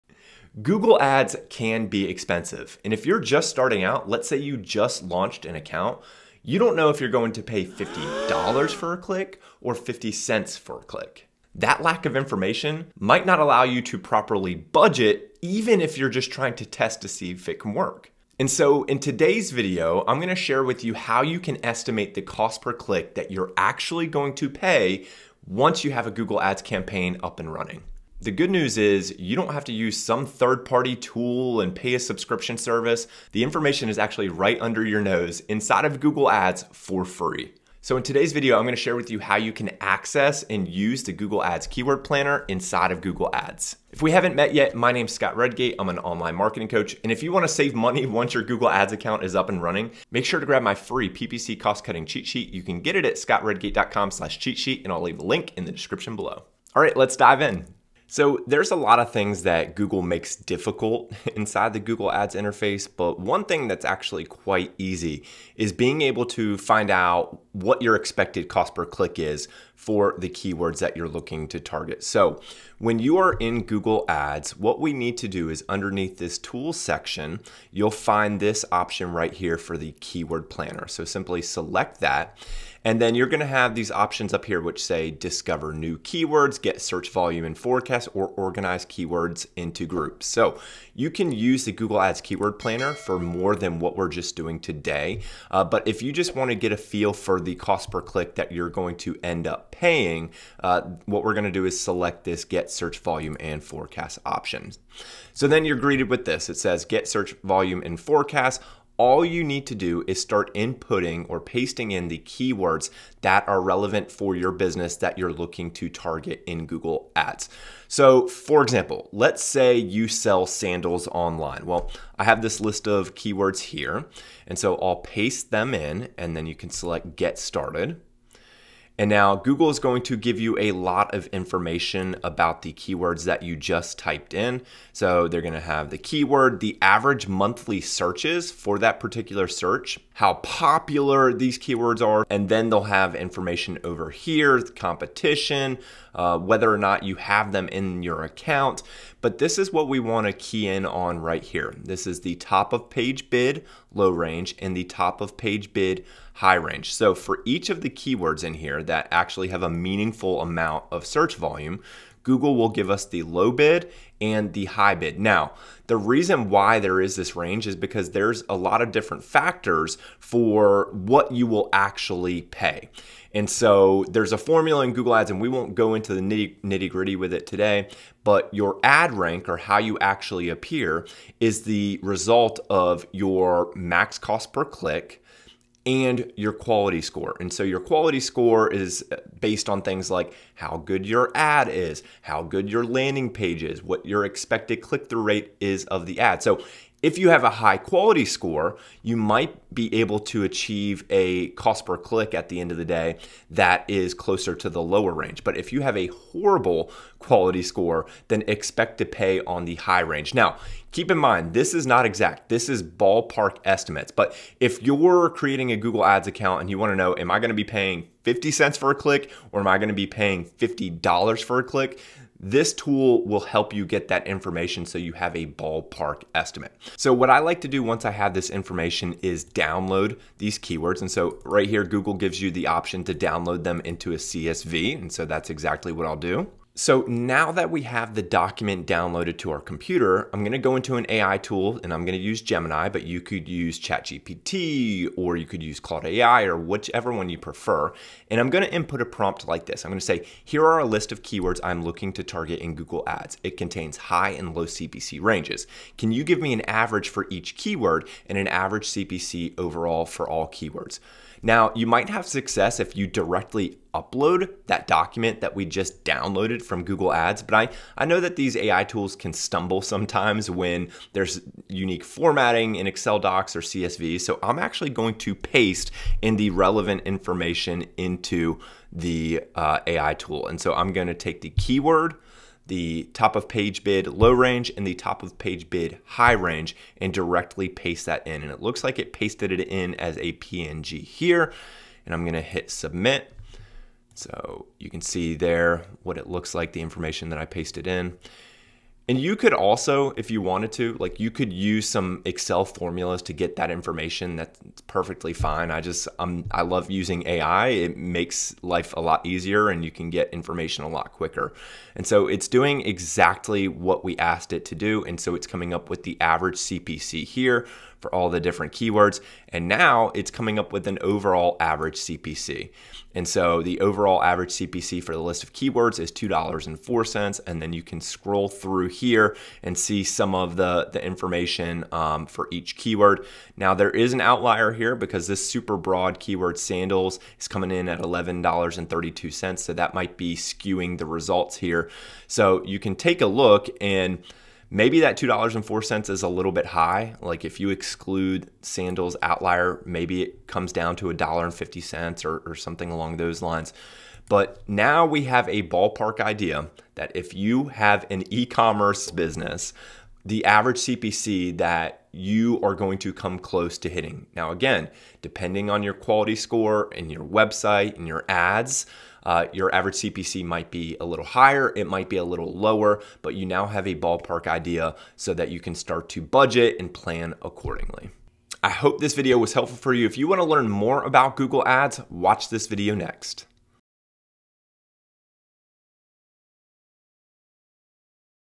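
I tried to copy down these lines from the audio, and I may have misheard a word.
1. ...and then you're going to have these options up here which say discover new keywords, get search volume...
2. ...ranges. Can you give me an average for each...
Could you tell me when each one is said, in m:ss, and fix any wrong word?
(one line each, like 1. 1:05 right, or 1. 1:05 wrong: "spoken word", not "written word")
1. 1:22 right
2. 4:15 right.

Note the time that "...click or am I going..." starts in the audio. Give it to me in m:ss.
3:38.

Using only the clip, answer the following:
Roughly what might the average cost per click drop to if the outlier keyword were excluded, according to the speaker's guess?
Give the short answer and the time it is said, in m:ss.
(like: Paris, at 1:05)
$1.50, at 5:51.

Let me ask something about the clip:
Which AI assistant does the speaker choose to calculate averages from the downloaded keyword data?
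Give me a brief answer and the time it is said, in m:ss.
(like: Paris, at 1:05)
Gemini, at 4:02.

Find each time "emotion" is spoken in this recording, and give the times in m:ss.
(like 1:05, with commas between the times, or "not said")
not said.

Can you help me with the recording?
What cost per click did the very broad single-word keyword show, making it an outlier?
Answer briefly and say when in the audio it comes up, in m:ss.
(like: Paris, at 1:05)
$11.32, at 5:37.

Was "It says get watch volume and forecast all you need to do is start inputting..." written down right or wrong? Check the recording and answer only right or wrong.
wrong.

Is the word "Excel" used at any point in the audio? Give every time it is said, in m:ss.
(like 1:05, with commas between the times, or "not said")
4:32, 5:02.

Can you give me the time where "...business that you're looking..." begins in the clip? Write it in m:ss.
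1:54.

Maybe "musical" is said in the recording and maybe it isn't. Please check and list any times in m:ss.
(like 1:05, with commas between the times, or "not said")
not said.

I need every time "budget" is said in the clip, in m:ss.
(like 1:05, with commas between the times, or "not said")
0:14, 6:16.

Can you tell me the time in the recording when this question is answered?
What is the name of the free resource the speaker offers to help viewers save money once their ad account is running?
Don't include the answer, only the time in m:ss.
0:51.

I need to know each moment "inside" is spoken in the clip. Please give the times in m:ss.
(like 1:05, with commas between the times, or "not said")
0:35, 0:42, 1:01.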